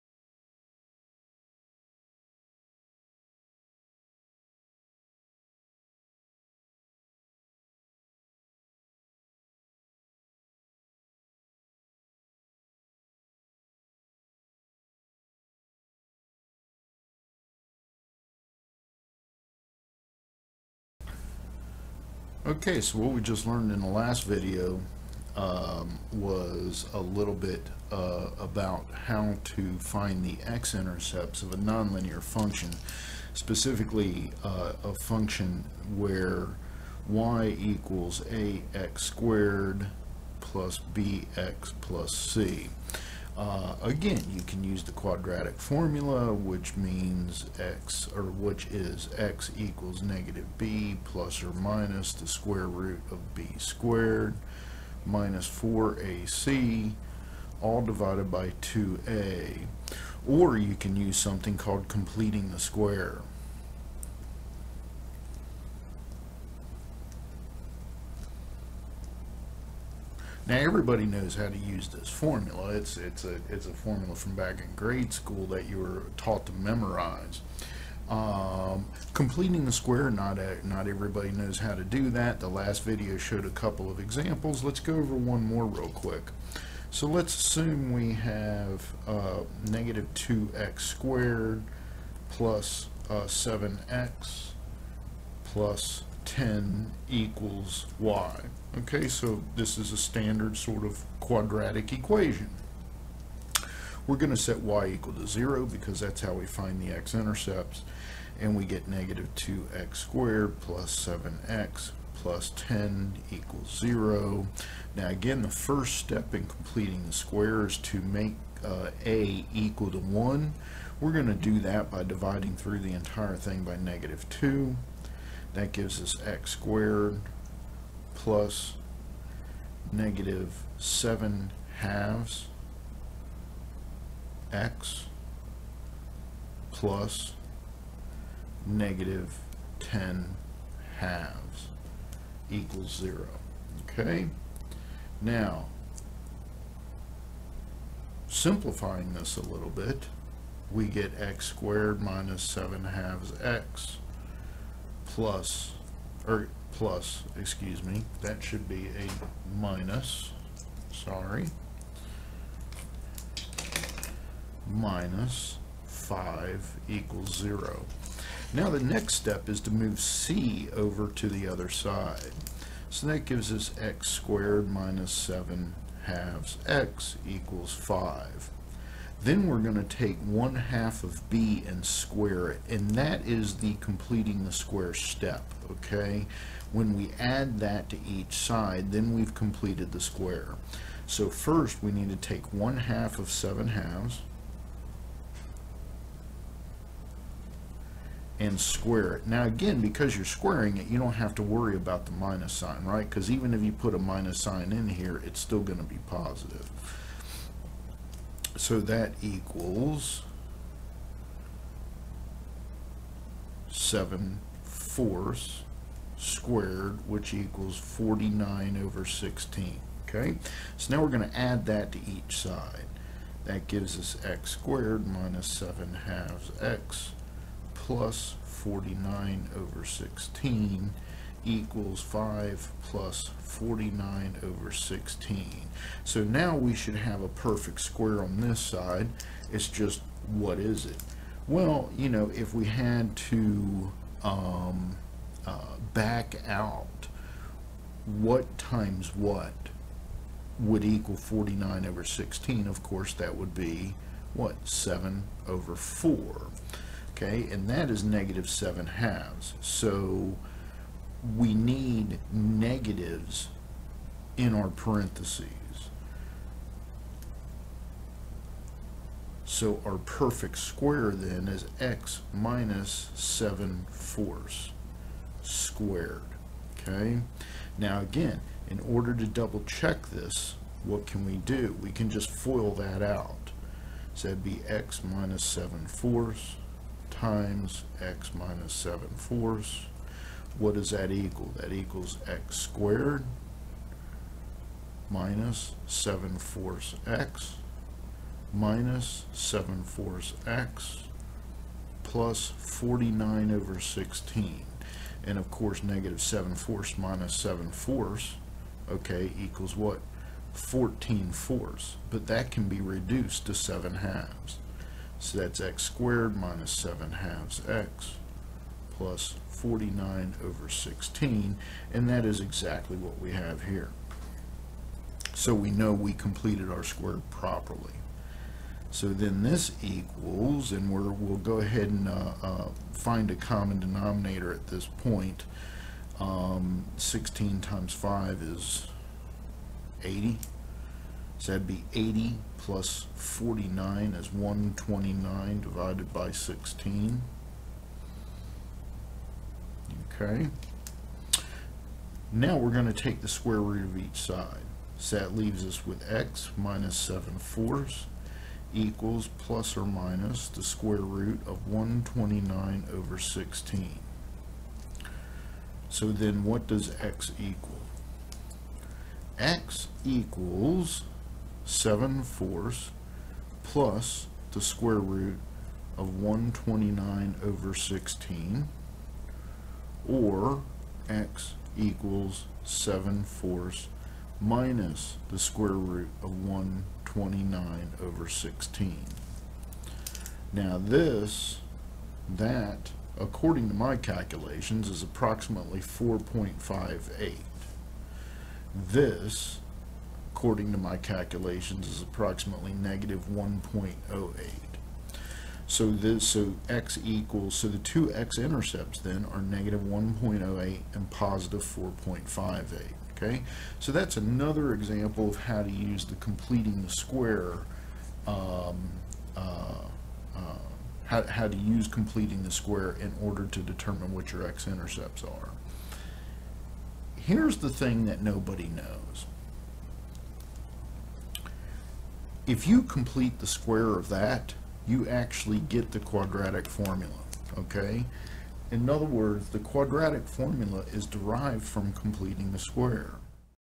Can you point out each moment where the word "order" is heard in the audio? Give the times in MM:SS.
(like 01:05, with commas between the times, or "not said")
04:38, 07:03.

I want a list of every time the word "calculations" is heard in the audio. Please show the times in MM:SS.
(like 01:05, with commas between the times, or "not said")
06:33, 06:40.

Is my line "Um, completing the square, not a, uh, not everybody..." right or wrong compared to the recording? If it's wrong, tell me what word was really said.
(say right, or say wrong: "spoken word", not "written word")
right.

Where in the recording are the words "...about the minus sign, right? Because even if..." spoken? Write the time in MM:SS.
03:21.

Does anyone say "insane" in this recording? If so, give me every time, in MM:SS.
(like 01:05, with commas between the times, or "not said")
not said.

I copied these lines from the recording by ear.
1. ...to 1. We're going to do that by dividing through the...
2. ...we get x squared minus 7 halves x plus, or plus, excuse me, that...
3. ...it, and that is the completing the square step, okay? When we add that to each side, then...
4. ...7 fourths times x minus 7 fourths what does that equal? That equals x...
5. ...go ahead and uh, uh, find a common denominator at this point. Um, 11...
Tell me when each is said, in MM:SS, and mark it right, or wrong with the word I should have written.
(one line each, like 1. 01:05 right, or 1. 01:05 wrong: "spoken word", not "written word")
1. 01:59 right
2. 02:30 right
3. 03:02 right
4. 04:45 right
5. 05:31 wrong: "16", not "11".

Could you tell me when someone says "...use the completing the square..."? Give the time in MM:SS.
06:55.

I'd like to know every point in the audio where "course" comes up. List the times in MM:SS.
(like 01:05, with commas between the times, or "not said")
04:12, 05:05.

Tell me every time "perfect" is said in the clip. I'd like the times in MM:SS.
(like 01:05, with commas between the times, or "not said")
03:57, 04:29.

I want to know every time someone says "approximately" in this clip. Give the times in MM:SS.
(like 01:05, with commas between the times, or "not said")
06:35, 06:42.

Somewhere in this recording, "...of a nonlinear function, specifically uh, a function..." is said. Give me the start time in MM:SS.
00:31.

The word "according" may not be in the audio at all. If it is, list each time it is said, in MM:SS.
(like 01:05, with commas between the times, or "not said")
06:33, 06:40.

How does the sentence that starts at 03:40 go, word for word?
Okay, so now we're going to add that to each side.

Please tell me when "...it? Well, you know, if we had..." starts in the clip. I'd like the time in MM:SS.
04:00.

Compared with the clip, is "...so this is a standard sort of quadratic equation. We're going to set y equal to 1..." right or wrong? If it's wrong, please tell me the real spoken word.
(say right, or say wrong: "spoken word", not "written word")
wrong: "0", not "1".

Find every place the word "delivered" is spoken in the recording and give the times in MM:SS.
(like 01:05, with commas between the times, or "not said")
not said.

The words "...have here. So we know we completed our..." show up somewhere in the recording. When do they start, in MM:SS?
05:23.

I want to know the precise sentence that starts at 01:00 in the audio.
Or you can use something called completing the square.